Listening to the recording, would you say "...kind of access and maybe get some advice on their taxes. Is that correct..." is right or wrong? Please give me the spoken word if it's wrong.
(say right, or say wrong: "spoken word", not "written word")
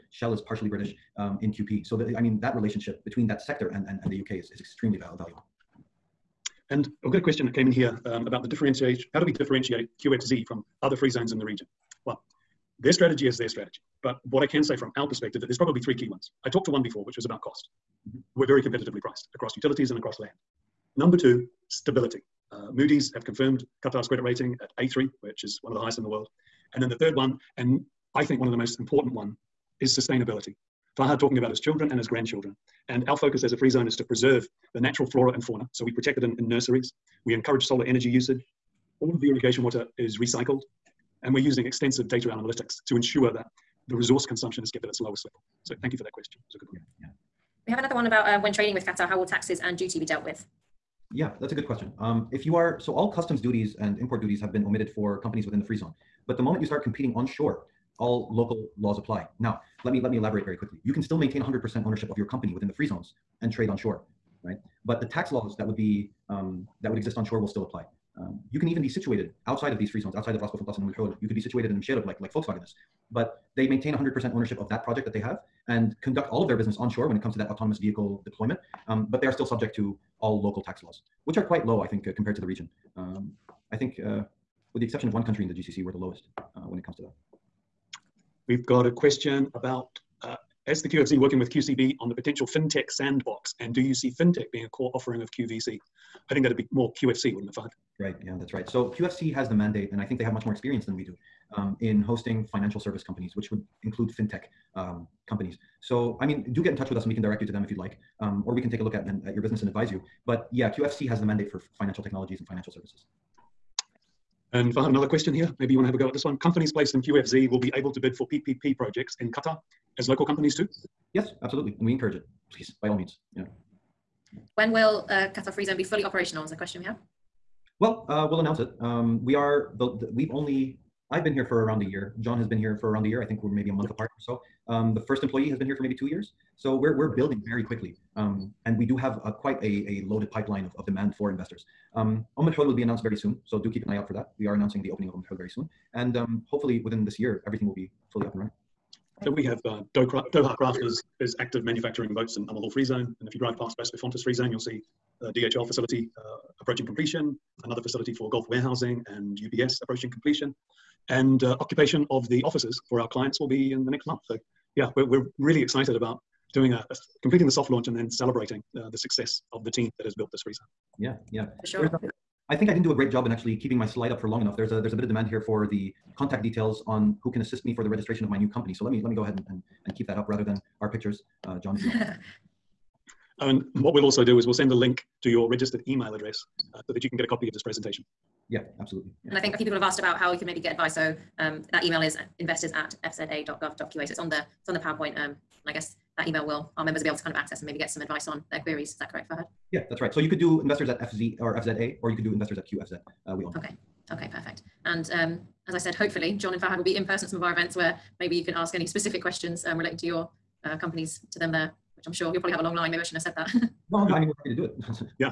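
wrong: "queries", not "taxes".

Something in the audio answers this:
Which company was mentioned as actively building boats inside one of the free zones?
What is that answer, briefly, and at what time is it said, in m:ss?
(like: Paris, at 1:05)
Doha Crafters, at 2:29.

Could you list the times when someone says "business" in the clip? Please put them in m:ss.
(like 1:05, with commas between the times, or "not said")
1:16, 1:49.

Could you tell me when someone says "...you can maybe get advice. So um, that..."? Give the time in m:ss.
3:10.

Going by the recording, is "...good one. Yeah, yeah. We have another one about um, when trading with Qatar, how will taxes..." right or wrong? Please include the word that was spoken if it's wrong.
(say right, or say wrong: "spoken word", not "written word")
right.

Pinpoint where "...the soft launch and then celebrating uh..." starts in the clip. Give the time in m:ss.
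2:47.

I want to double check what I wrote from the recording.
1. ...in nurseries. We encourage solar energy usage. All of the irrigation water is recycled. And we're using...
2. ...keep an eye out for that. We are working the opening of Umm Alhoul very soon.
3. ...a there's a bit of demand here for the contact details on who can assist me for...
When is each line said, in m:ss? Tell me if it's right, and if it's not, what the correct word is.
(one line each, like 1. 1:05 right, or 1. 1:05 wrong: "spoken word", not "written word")
1. 0:36 right
2. 2:23 wrong: "announcing", not "working"
3. 2:54 right.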